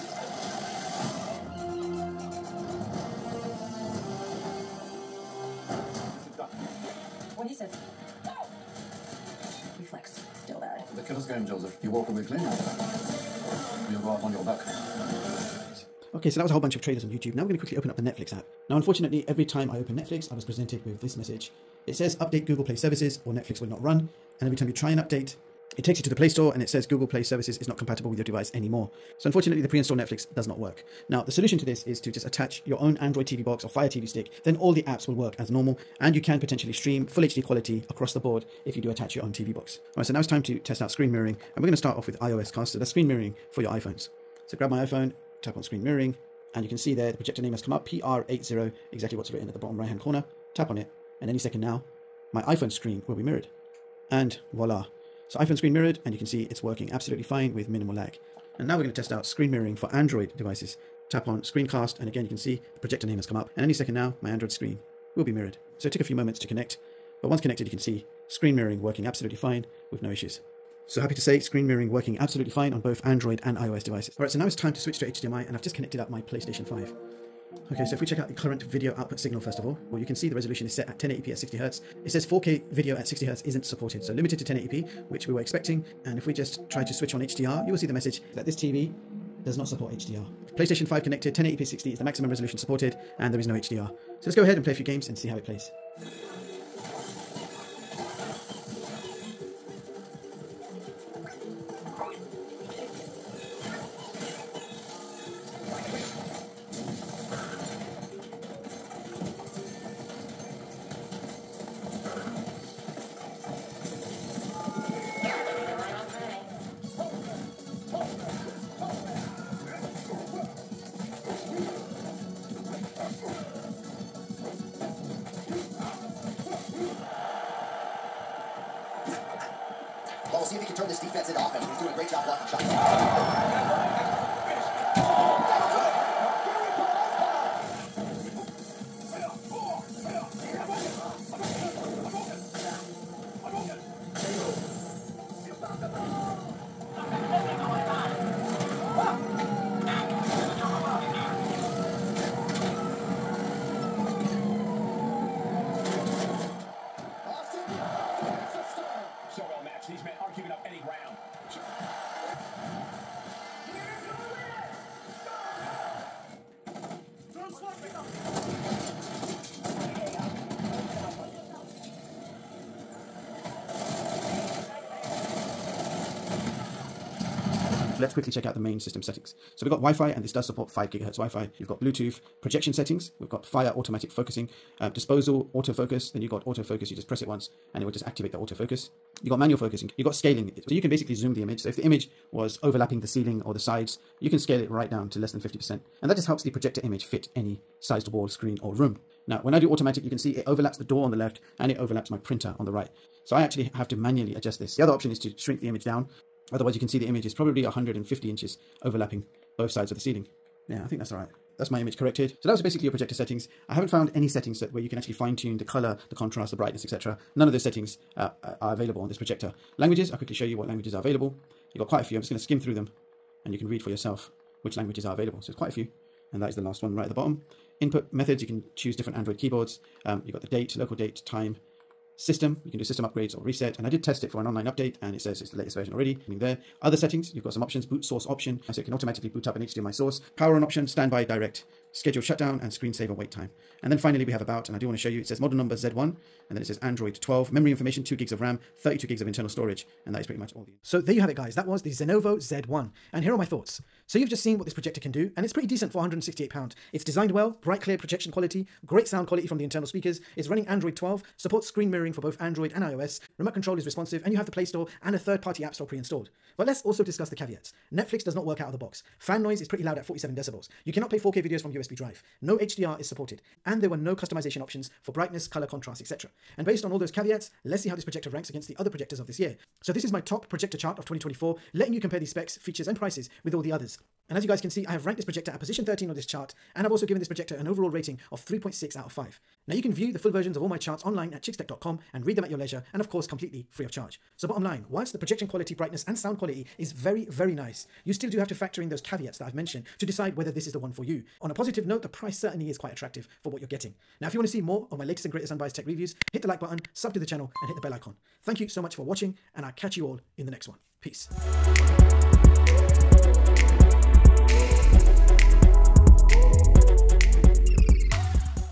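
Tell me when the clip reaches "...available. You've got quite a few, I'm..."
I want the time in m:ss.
3:41.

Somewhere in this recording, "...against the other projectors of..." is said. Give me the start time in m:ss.
4:38.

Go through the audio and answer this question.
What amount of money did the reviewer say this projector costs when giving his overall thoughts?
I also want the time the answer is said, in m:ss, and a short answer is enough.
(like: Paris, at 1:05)
£168, at 4:15.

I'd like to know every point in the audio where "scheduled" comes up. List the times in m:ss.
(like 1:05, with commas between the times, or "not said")
4:01.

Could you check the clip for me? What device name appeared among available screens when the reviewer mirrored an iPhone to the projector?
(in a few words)
PR80.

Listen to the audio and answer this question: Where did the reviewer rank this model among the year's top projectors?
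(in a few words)
13.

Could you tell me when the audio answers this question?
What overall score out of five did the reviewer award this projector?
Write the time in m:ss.
4:48.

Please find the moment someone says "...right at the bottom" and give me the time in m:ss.
3:46.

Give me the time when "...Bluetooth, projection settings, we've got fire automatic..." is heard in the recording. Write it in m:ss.
3:01.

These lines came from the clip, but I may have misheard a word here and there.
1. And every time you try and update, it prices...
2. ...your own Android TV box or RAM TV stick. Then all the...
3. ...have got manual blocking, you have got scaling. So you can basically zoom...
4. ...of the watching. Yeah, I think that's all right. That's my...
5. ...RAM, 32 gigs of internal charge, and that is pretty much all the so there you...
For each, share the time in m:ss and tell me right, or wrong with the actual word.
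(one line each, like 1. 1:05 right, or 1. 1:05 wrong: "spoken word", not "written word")
1. 0:24 wrong: "takes", not "prices"
2. 0:32 wrong: "Fire", not "RAM"
3. 3:09 wrong: "focusing", not "blocking"
4. 3:29 wrong: "ceiling", not "watching"
5. 4:08 wrong: "storage", not "charge".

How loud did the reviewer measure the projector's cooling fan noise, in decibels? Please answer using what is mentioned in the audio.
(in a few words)
47 decibels.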